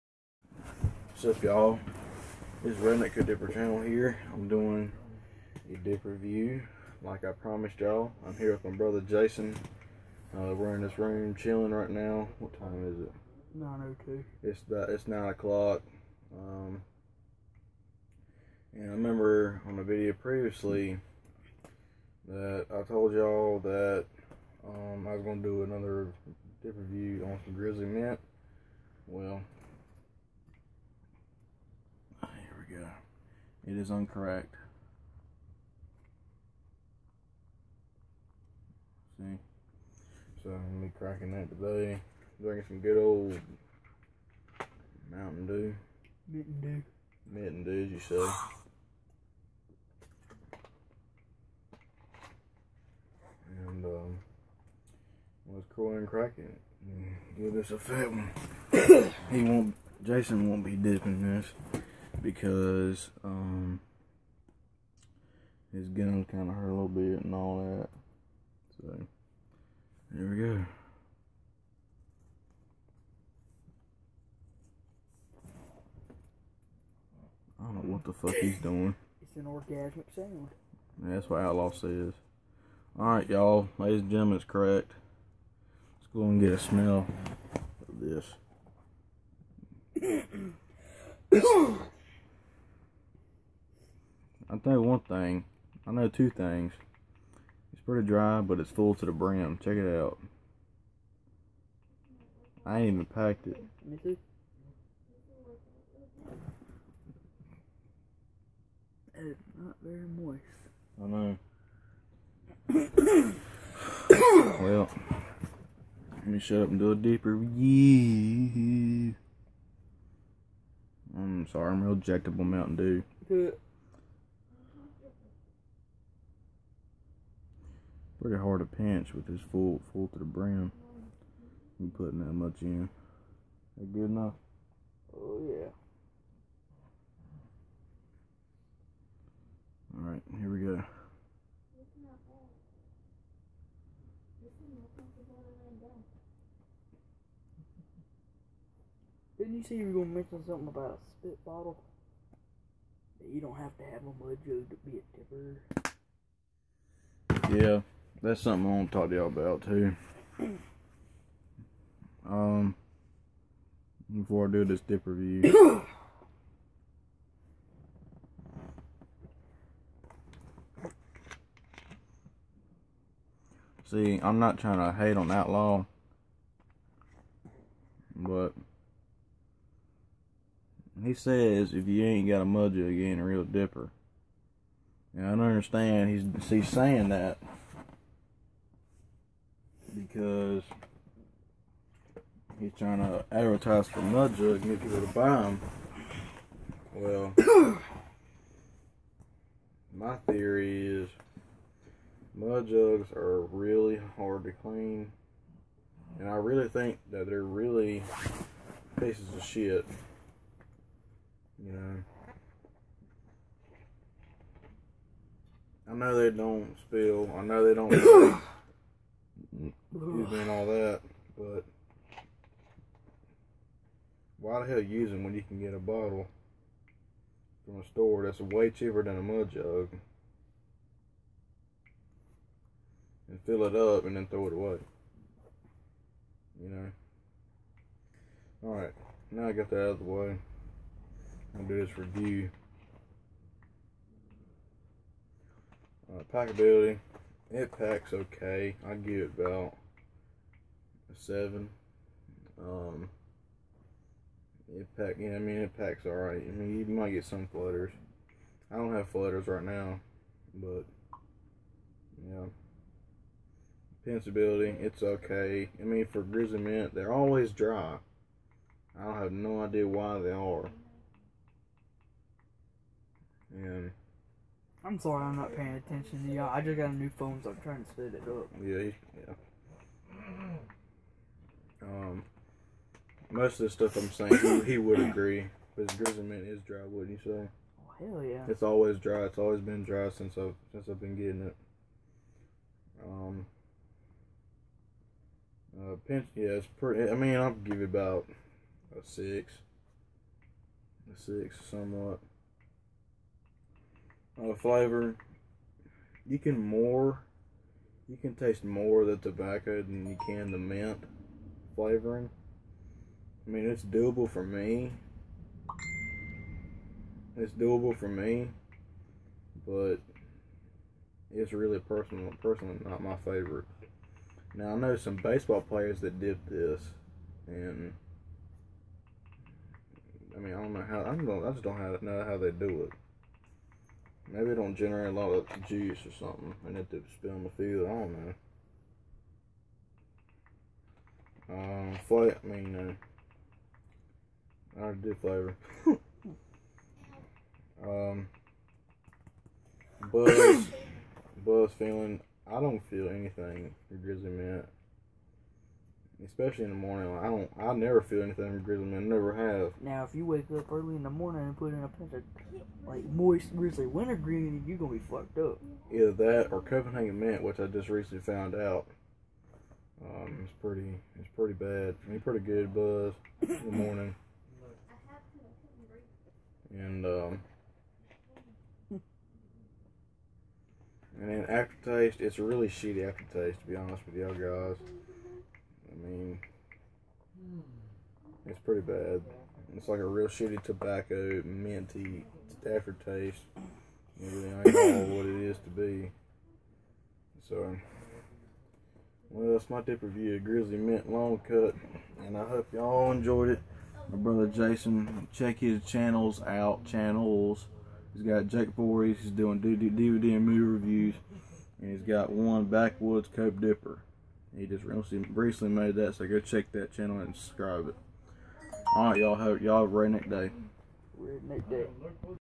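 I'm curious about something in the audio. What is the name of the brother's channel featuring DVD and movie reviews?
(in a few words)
Jake Voorhees.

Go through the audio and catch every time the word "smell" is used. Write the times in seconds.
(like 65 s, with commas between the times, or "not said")
86 s.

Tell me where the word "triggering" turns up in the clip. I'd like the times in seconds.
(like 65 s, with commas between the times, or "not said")
not said.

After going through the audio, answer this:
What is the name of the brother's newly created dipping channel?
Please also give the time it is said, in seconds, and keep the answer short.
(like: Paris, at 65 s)
Backwoods Cope Dipper, at 412 s.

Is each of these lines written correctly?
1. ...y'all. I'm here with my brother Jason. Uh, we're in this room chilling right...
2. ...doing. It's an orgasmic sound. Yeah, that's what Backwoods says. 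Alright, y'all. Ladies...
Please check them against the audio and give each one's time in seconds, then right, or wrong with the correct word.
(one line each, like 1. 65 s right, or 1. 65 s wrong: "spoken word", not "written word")
1. 7 s right
2. 78 s wrong: "Outlaw", not "Backwoods".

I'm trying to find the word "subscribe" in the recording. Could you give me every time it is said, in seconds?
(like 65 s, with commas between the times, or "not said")
417 s.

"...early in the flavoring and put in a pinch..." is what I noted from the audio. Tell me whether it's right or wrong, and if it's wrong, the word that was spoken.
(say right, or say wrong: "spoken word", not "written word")
wrong: "morning", not "flavoring".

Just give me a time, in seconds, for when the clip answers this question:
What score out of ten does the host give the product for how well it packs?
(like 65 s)
251 s.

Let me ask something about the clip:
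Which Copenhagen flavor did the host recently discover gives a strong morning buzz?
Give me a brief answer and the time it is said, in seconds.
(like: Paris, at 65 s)
Copenhagen Mint, at 366 s.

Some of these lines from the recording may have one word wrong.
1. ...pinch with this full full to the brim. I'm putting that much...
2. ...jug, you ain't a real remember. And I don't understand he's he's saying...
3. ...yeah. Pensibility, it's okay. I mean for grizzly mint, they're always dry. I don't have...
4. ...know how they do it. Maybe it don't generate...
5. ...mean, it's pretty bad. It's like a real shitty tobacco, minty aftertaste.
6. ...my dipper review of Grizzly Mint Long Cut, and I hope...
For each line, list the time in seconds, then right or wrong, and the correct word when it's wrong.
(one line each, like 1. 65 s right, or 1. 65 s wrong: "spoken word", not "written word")
1. 128 s right
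2. 182 s wrong: "dipper", not "remember"
3. 262 s right
4. 332 s right
5. 386 s right
6. 399 s right.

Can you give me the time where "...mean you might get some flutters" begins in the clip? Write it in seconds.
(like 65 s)
256 s.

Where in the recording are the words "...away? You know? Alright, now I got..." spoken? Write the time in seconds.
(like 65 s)
234 s.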